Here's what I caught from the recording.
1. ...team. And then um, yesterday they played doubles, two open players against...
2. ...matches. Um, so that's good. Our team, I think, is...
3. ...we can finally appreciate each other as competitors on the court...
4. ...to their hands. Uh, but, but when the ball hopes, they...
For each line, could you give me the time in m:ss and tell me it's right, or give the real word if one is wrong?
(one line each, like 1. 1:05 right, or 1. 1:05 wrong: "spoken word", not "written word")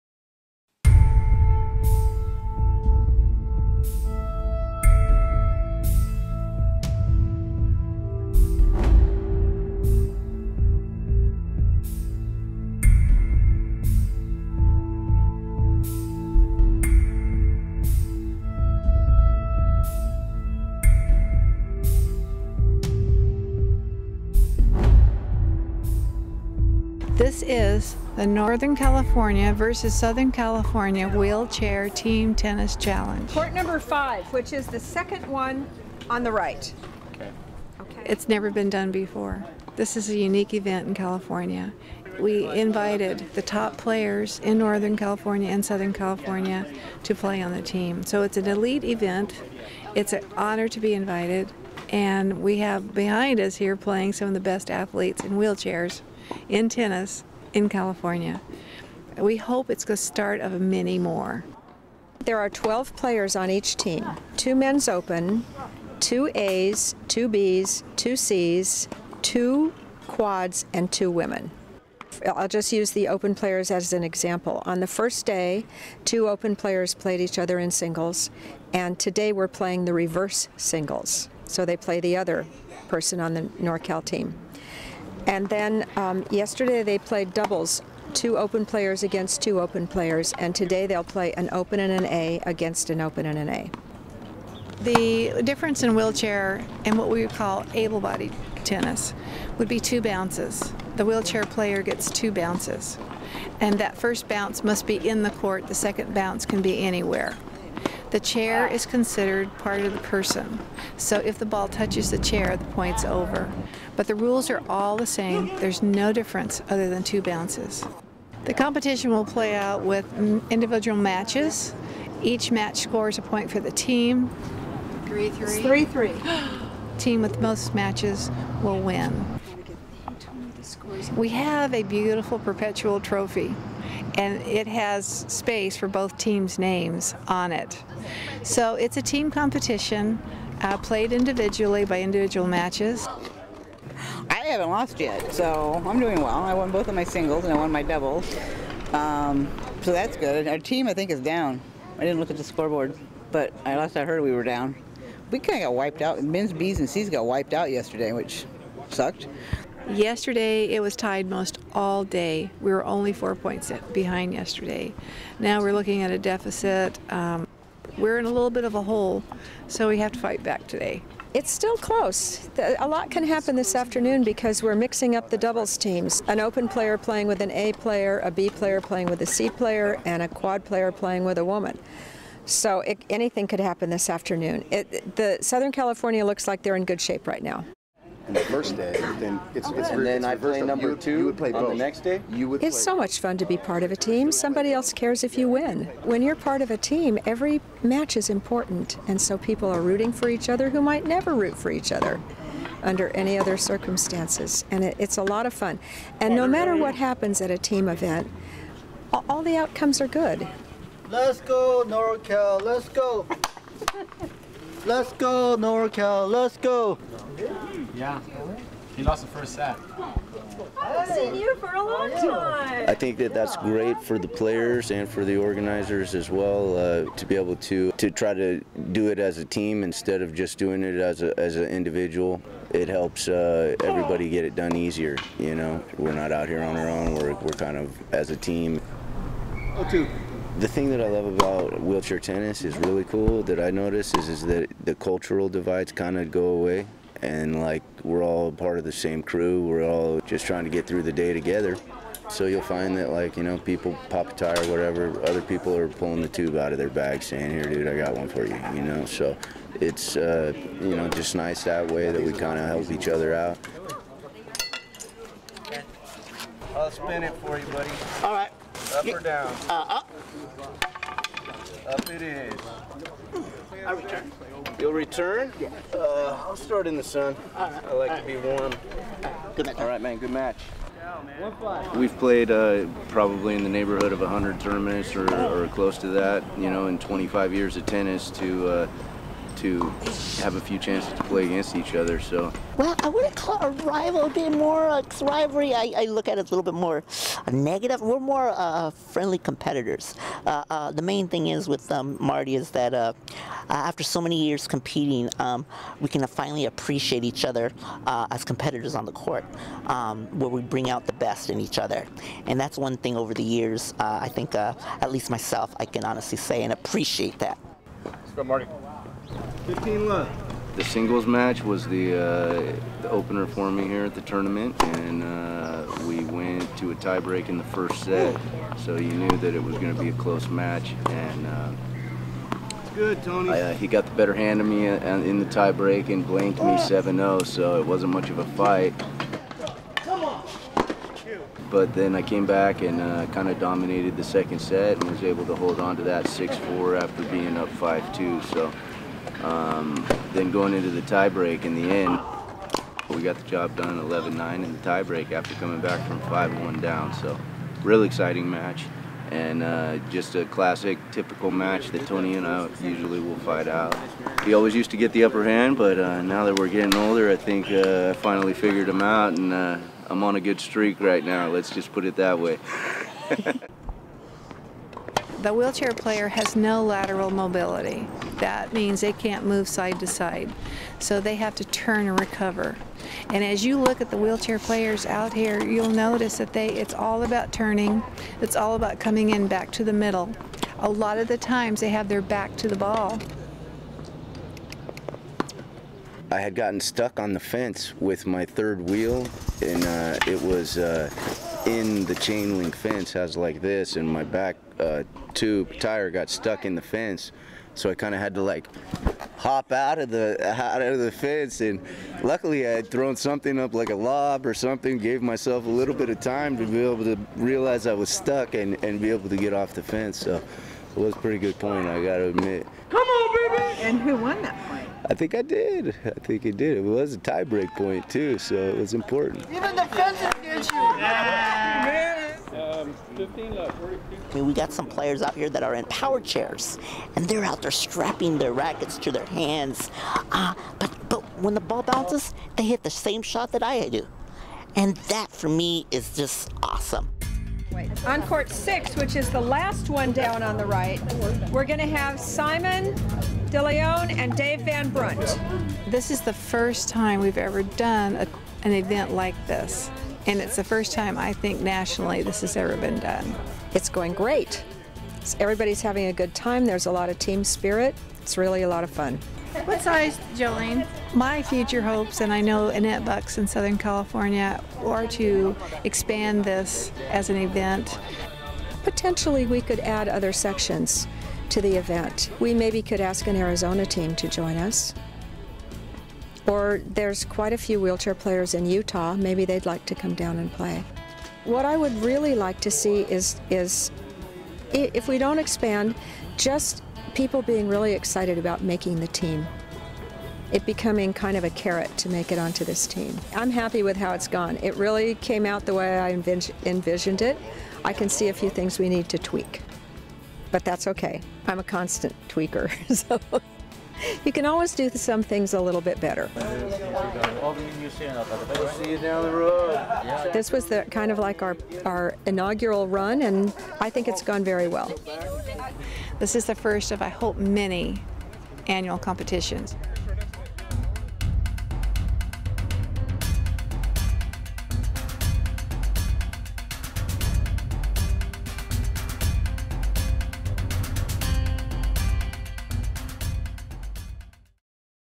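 1. 1:24 right
2. 2:27 wrong: "doubles", not "matches"
3. 5:05 right
4. 7:18 wrong: "bounces", not "hopes".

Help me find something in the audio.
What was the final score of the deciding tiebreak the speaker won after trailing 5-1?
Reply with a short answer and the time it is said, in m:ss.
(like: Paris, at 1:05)
11-9, at 5:53.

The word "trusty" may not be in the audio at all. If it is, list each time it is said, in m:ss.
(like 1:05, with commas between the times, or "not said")
not said.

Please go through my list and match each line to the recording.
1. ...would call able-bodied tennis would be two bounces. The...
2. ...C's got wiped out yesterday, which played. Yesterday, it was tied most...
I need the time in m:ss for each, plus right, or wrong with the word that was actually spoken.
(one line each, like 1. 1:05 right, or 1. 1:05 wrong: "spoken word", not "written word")
1. 1:37 right
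2. 2:36 wrong: "sucked", not "played".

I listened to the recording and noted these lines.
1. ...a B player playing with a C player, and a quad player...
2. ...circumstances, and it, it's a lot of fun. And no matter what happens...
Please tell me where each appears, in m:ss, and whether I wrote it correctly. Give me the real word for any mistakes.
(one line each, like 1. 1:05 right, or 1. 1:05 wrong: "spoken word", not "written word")
1. 2:58 right
2. 3:23 right.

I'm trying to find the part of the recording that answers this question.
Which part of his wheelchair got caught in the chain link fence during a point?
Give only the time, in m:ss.
6:38.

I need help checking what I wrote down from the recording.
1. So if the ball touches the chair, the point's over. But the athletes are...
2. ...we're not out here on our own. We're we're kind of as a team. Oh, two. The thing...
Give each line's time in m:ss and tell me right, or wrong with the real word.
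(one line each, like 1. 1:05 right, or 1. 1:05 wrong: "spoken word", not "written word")
1. 1:50 wrong: "rules", not "athletes"
2. 3:55 right.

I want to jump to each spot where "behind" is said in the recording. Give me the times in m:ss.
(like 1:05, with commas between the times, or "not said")
0:52, 2:43.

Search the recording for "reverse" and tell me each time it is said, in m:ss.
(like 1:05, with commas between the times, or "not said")
1:19.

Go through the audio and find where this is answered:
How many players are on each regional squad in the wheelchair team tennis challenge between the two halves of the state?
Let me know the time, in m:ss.
1:02.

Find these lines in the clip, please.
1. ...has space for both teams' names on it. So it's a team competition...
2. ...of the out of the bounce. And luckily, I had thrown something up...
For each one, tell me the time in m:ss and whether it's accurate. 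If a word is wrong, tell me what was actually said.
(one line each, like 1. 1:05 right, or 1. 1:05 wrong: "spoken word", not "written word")
1. 2:14 right
2. 6:49 wrong: "fence", not "bounce".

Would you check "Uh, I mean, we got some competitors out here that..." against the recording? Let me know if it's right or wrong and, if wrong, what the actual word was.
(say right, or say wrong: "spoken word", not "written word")
wrong: "players", not "competitors".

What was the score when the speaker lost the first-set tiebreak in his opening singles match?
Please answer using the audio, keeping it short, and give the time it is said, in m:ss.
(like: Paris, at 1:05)
7-0, at 5:36.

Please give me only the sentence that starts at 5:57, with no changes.
So, real exciting match, and uh, just a classic, typical match that Tony and I usually will fight out.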